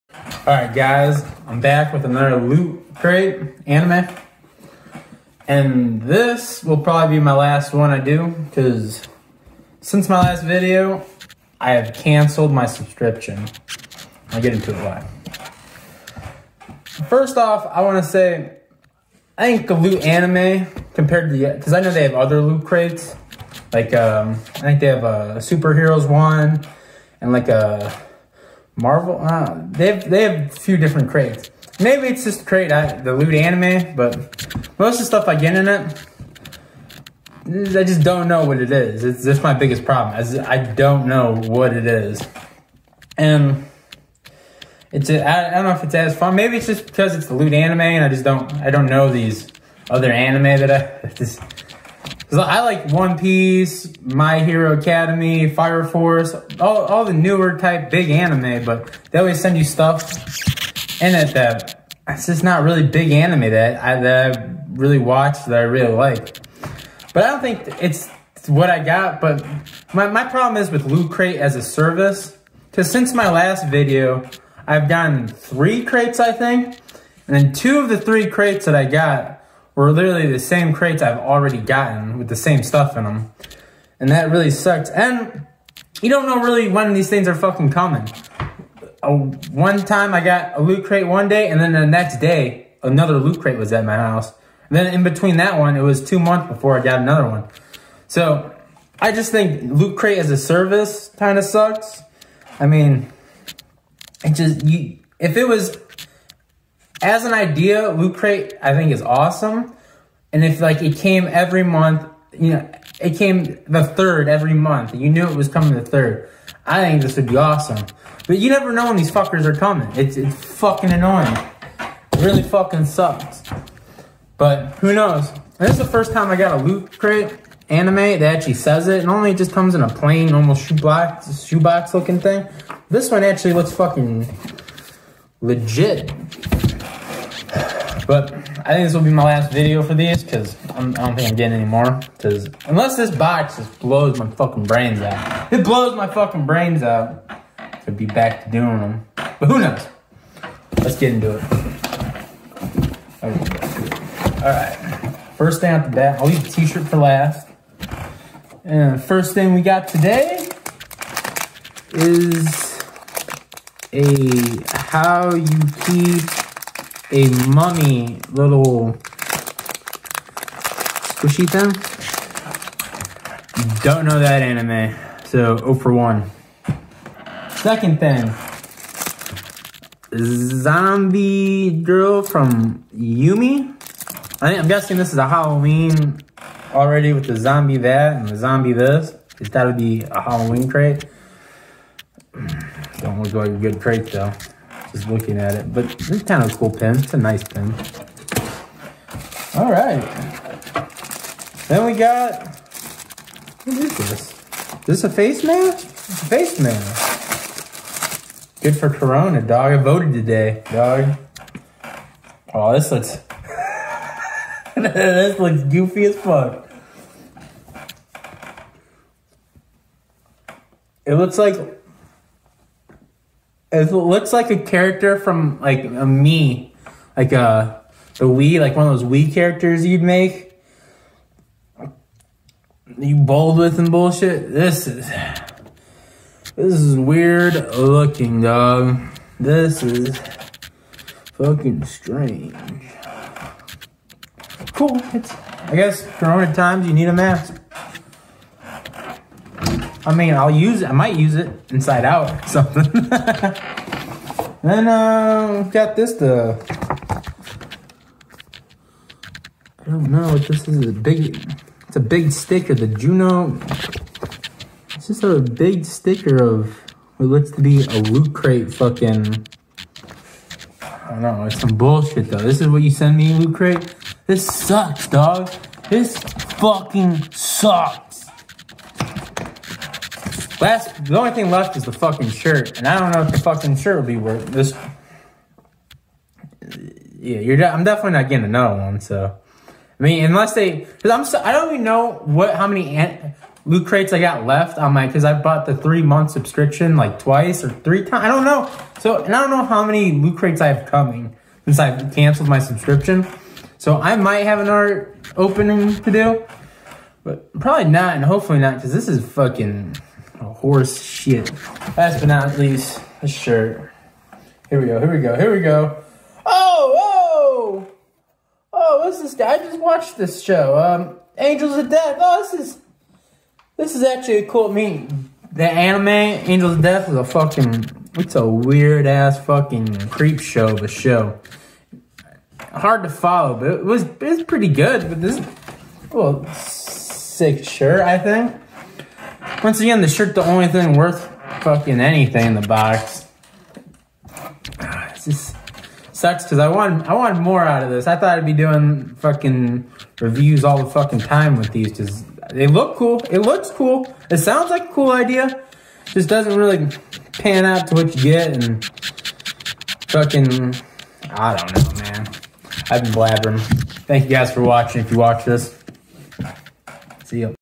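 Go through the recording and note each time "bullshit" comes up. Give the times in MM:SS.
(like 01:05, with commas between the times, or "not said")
03:53, 04:31.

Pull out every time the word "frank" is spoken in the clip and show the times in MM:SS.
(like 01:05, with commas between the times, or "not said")
not said.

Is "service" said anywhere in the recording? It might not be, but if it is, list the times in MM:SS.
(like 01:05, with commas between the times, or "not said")
01:11, 01:40.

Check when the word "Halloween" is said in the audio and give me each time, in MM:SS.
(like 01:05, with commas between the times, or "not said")
03:05, 03:10.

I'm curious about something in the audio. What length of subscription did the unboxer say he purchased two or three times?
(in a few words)
3 months.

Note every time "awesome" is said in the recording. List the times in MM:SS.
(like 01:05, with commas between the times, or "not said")
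01:49, 01:57.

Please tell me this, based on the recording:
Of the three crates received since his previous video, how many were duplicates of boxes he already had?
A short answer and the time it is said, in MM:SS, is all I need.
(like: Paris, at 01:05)
2, at 01:17.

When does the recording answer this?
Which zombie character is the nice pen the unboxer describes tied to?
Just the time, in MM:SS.
03:00.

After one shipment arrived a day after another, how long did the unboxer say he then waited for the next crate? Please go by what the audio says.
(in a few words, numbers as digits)
2 months.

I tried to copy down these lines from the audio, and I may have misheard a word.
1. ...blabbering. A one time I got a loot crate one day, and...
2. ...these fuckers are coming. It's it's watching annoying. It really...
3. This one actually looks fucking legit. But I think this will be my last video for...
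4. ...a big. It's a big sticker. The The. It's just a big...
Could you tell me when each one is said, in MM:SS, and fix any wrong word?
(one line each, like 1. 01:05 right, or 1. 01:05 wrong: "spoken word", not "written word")
1. 01:27 wrong: "coming", not "blabbering"
2. 01:58 wrong: "fucking", not "watching"
3. 02:12 right
4. 04:20 wrong: "Juno", not "The".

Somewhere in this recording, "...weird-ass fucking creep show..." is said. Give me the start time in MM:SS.
05:28.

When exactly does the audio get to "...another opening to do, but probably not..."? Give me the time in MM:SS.
05:04.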